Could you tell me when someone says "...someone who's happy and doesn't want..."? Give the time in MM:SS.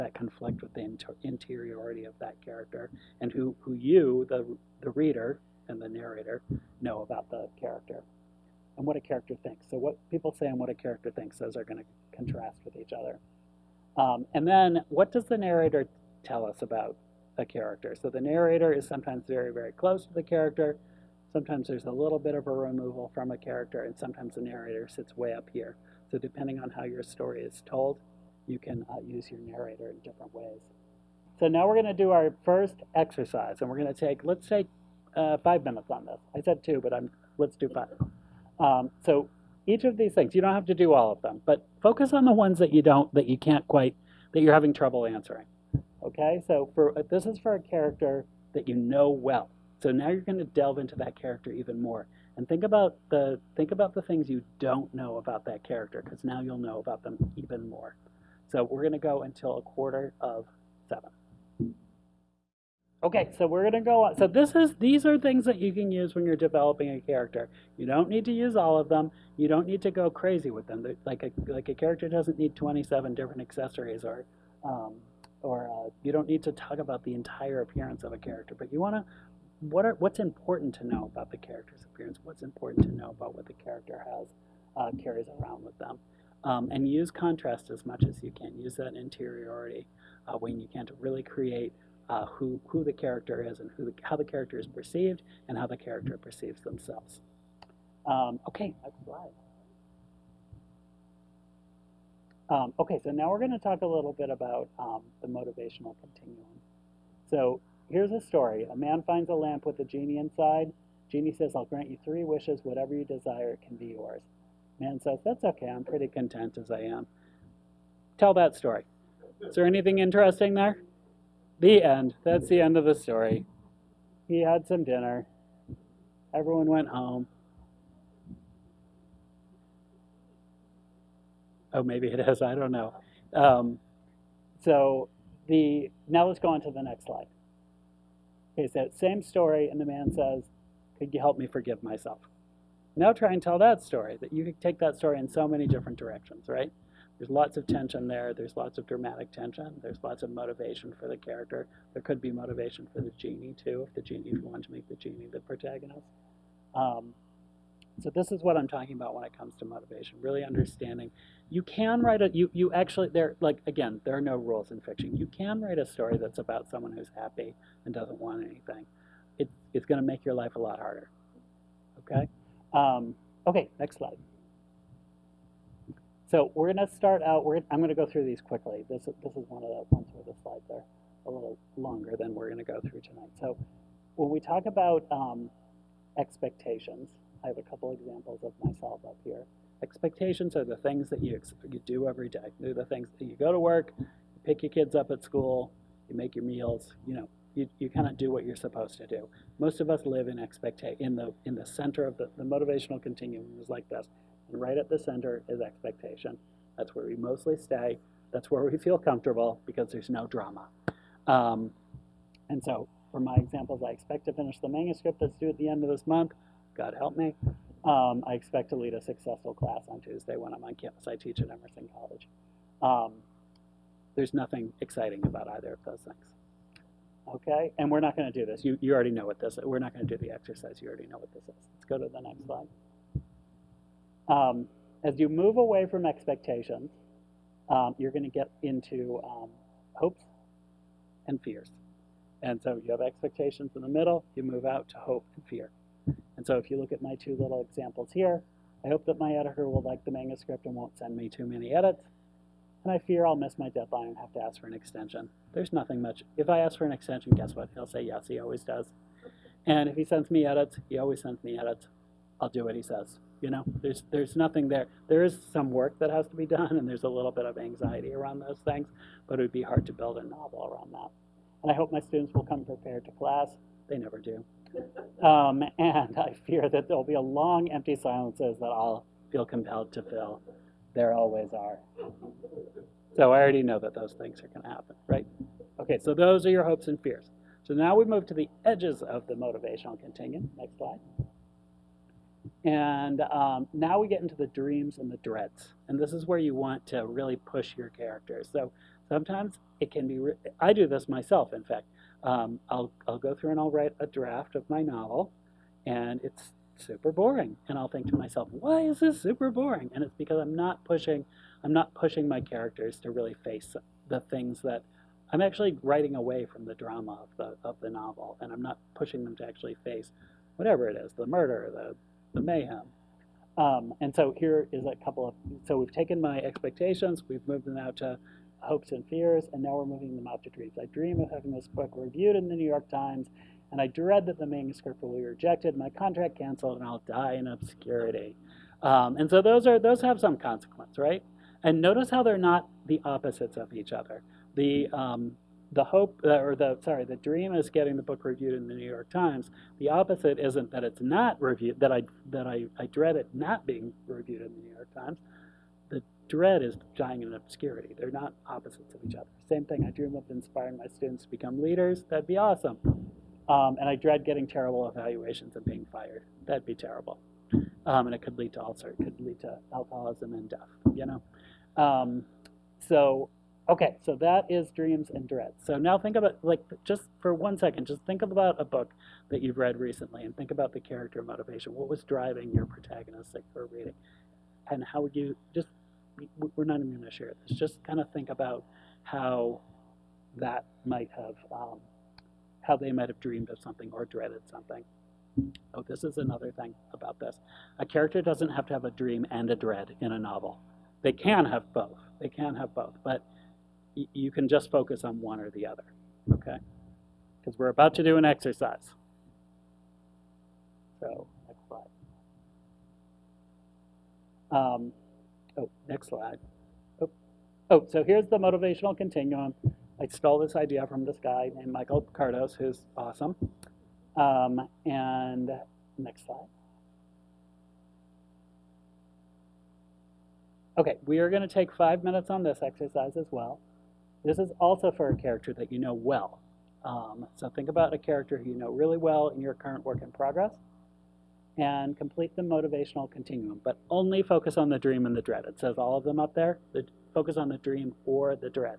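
02:46.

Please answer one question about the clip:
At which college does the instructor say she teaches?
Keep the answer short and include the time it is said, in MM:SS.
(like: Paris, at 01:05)
Emerson College, at 03:41.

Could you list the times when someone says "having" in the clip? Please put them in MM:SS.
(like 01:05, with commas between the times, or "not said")
00:44, 05:31.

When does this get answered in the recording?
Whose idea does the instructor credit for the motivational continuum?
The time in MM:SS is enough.
07:01.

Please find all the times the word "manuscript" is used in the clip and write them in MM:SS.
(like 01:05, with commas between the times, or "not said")
03:34, 04:10, 05:34.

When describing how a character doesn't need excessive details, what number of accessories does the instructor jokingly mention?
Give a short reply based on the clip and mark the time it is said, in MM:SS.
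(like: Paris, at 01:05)
27, at 01:12.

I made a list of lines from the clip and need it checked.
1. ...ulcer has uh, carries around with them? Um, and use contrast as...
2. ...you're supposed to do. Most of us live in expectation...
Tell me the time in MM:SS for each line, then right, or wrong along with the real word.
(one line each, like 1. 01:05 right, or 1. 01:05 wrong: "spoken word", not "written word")
1. 01:23 wrong: "character", not "ulcer"
2. 03:18 right.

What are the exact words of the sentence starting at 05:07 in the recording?
And I'll think to myself, why is this super boring?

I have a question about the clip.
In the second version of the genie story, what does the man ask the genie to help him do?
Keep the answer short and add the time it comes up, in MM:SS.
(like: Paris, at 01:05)
Forgive myself, at 02:21.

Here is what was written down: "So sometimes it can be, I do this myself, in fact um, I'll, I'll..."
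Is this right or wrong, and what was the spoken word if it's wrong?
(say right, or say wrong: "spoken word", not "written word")
right.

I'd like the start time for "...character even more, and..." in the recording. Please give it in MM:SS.
00:51.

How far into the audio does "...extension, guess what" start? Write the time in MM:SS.
04:16.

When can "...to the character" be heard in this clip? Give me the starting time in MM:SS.
00:20.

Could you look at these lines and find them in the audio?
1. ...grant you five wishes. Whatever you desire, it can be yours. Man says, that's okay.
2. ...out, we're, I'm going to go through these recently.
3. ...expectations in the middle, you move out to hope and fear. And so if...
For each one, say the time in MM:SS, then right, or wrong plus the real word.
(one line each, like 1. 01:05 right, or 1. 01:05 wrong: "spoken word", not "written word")
1. 01:51 wrong: "three", not "five"
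2. 02:57 wrong: "quickly", not "recently"
3. 04:03 right.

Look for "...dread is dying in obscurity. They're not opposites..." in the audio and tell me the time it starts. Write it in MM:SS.
05:56.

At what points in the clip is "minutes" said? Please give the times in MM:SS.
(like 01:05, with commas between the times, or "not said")
00:35, 07:12.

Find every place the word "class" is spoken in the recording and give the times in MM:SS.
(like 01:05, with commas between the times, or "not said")
03:39, 04:33.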